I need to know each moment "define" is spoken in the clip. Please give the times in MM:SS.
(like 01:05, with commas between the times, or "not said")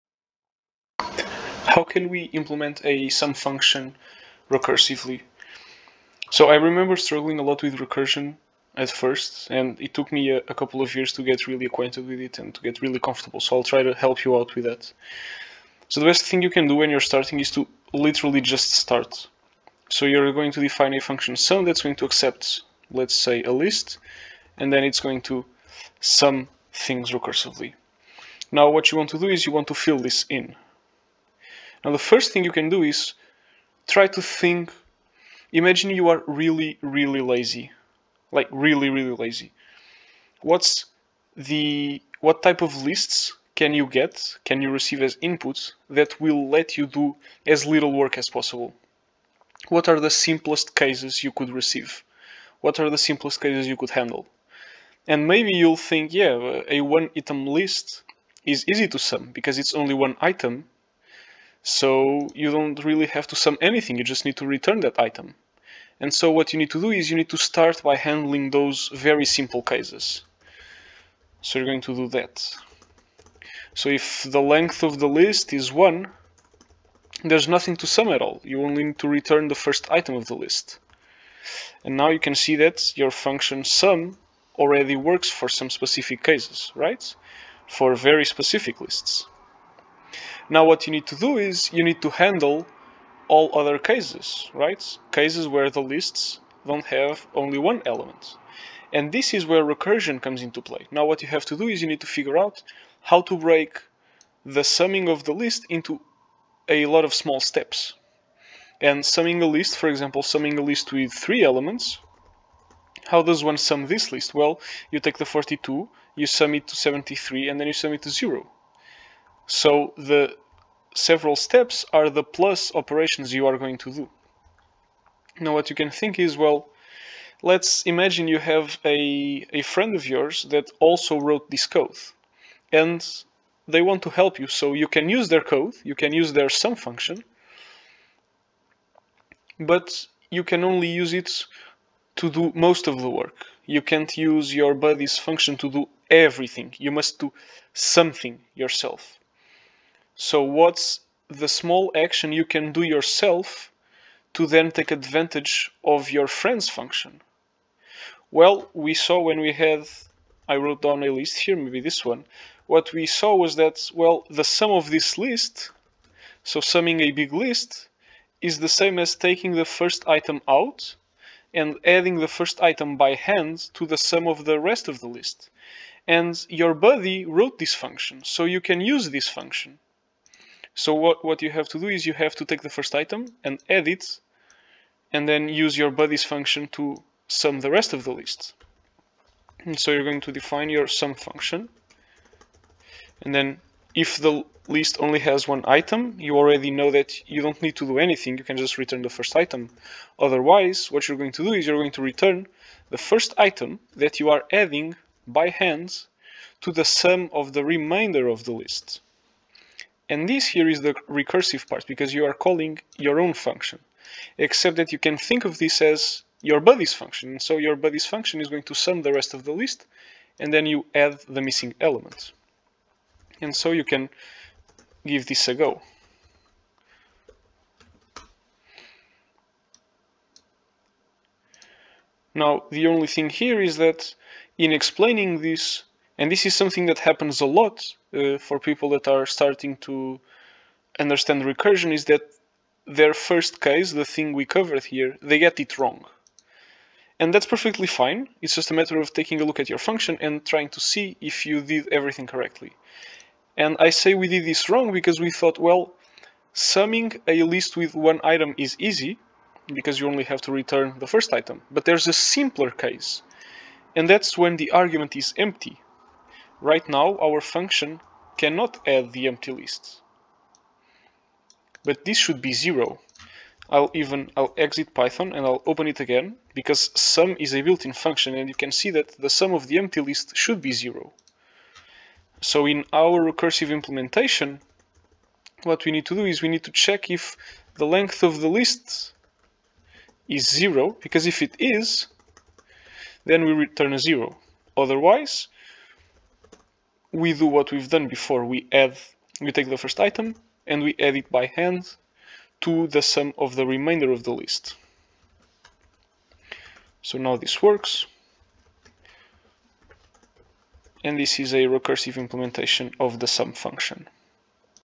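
00:20, 03:10.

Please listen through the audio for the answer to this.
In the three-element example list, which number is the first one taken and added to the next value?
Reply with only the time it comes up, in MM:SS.
01:55.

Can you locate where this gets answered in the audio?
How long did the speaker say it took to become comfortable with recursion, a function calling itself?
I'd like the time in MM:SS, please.
00:10.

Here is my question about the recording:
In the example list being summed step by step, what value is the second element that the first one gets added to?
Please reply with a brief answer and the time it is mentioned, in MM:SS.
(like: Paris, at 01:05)
73, at 01:56.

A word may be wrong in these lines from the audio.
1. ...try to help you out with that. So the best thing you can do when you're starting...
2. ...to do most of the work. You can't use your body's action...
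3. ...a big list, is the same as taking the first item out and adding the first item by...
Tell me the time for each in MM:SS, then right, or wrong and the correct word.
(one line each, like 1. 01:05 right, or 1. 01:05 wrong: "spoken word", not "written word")
1. 00:13 right
2. 02:22 wrong: "function", not "action"
3. 02:46 right.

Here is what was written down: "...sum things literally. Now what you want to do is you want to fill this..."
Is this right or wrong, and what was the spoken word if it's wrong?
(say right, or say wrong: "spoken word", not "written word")
wrong: "recursively", not "literally".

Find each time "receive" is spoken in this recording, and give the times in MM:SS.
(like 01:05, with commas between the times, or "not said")
00:44, 00:51.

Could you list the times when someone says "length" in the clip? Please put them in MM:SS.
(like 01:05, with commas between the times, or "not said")
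01:14, 04:47.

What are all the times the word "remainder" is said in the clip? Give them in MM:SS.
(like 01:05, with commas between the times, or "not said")
03:27, 05:03.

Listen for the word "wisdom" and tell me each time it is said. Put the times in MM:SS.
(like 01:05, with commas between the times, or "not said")
not said.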